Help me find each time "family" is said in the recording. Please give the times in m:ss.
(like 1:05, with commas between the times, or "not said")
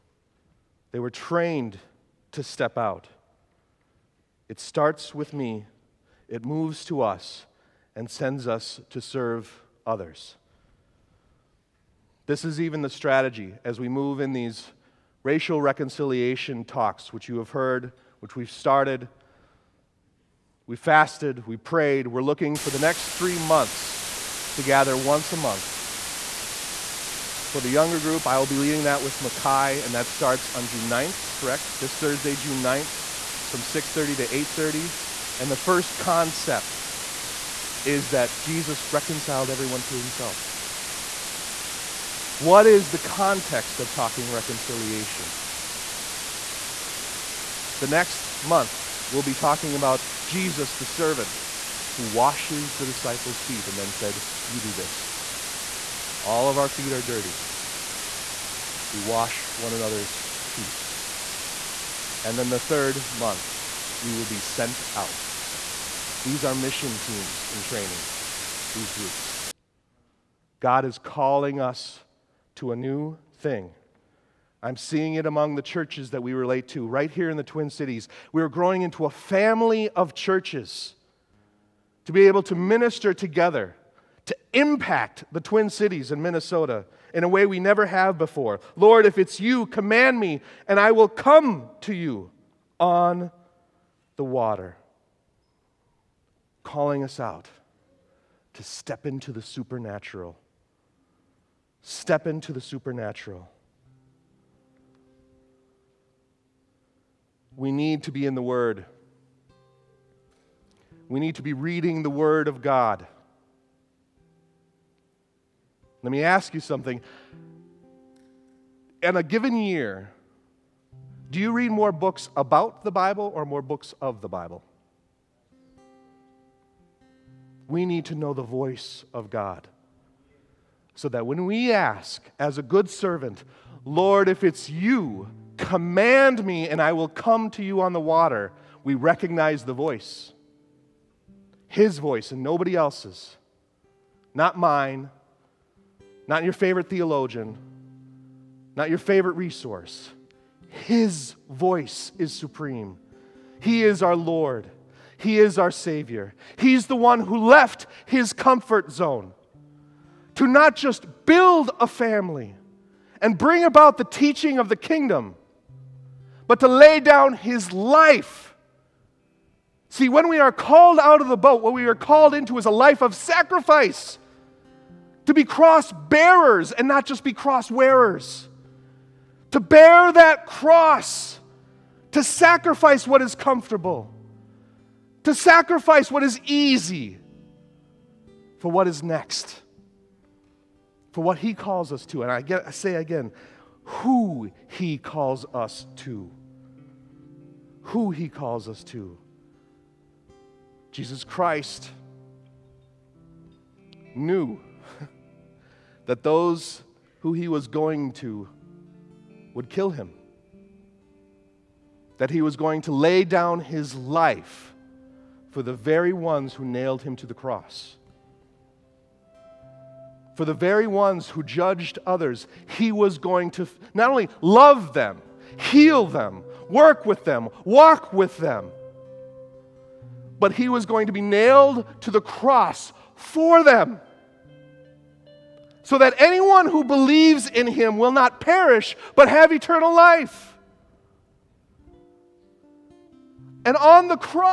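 1:19, 2:41.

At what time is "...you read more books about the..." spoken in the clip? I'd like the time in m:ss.
2:01.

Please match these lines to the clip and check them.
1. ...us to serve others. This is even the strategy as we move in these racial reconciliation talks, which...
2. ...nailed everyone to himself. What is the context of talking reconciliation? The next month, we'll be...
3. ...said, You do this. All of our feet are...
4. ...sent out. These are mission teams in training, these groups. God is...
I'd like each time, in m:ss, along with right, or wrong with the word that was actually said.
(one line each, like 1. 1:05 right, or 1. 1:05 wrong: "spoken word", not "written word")
1. 0:08 right
2. 0:38 wrong: "reconciled", not "nailed"
3. 0:53 right
4. 1:04 right.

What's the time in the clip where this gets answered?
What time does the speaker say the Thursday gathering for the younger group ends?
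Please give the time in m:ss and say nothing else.
0:34.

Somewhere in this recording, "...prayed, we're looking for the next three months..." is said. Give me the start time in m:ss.
0:21.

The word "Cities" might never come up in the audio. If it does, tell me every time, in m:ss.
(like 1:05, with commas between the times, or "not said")
1:17, 1:25.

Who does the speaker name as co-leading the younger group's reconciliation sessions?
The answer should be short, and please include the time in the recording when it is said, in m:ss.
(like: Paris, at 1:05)
Mackay, at 0:29.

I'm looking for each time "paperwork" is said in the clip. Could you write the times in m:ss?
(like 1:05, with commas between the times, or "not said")
not said.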